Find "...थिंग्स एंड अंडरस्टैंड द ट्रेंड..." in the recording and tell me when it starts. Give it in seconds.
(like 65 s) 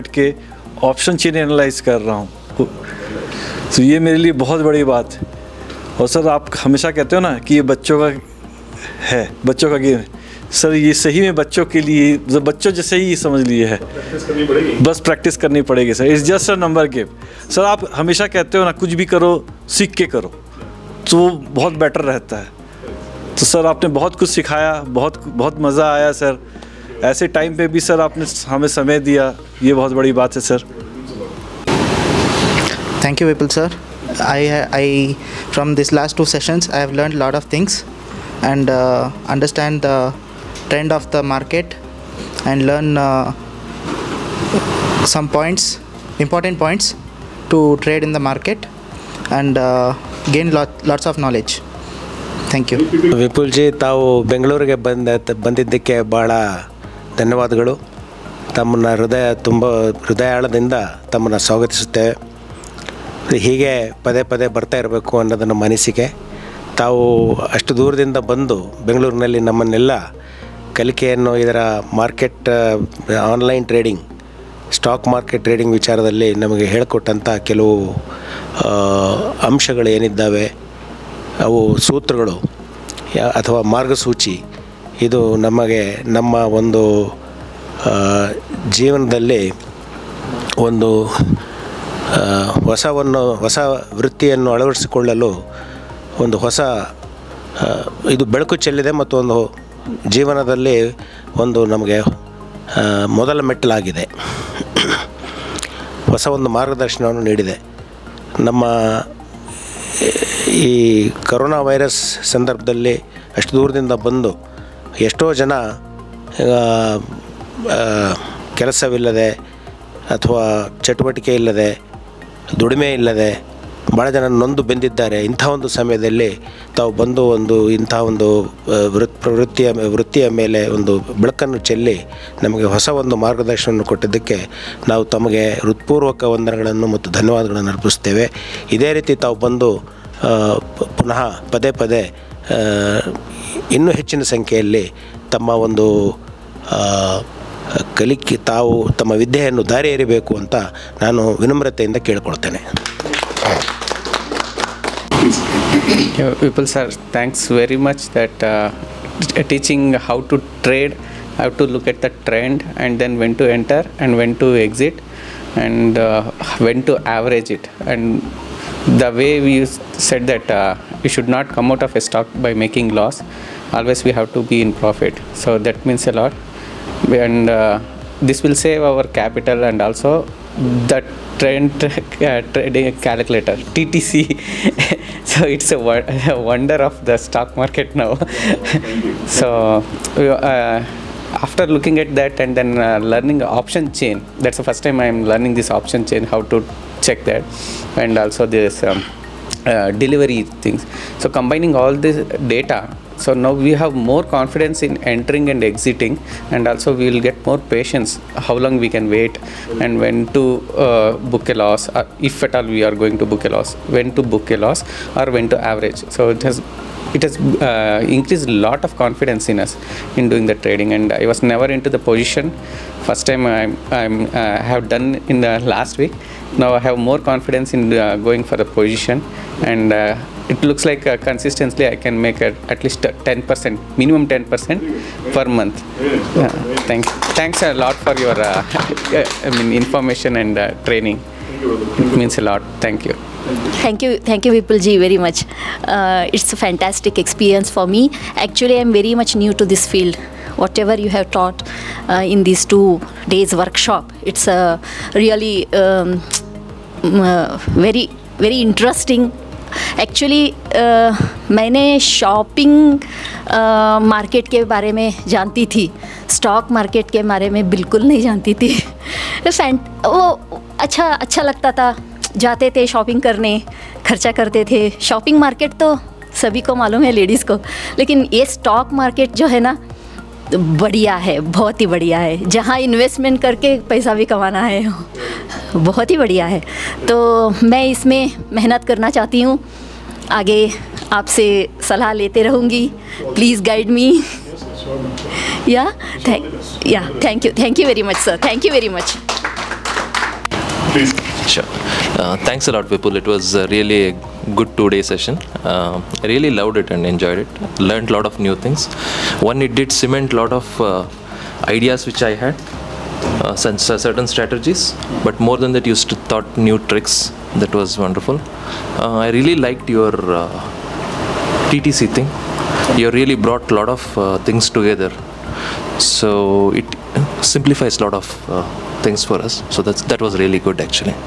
37 s.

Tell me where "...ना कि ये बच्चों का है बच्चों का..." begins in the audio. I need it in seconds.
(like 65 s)
7 s.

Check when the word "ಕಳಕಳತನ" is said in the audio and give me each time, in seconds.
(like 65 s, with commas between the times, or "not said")
152 s.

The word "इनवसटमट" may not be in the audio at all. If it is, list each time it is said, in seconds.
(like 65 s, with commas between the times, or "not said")
282 s.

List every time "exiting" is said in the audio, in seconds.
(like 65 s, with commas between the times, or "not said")
205 s.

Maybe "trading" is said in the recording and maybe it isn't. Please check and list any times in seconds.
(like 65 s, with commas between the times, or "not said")
182 s, 220 s.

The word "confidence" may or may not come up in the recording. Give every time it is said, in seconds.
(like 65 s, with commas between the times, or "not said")
204 s, 218 s, 227 s.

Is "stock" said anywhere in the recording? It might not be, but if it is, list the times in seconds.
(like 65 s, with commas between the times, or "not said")
171 s, 187 s.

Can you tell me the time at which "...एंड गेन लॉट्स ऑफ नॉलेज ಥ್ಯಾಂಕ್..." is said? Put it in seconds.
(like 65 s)
49 s.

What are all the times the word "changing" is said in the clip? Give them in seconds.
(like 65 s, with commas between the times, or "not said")
not said.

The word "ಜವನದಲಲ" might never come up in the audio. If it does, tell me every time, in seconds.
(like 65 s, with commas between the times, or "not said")
88 s, 100 s.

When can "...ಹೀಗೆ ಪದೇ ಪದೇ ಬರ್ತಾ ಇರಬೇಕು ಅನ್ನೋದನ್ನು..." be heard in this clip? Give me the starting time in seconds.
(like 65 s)
63 s.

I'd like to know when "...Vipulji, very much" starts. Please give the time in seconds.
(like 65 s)
244 s.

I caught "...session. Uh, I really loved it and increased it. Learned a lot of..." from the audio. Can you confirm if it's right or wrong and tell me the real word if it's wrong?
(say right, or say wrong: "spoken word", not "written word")
wrong: "enjoyed", not "increased".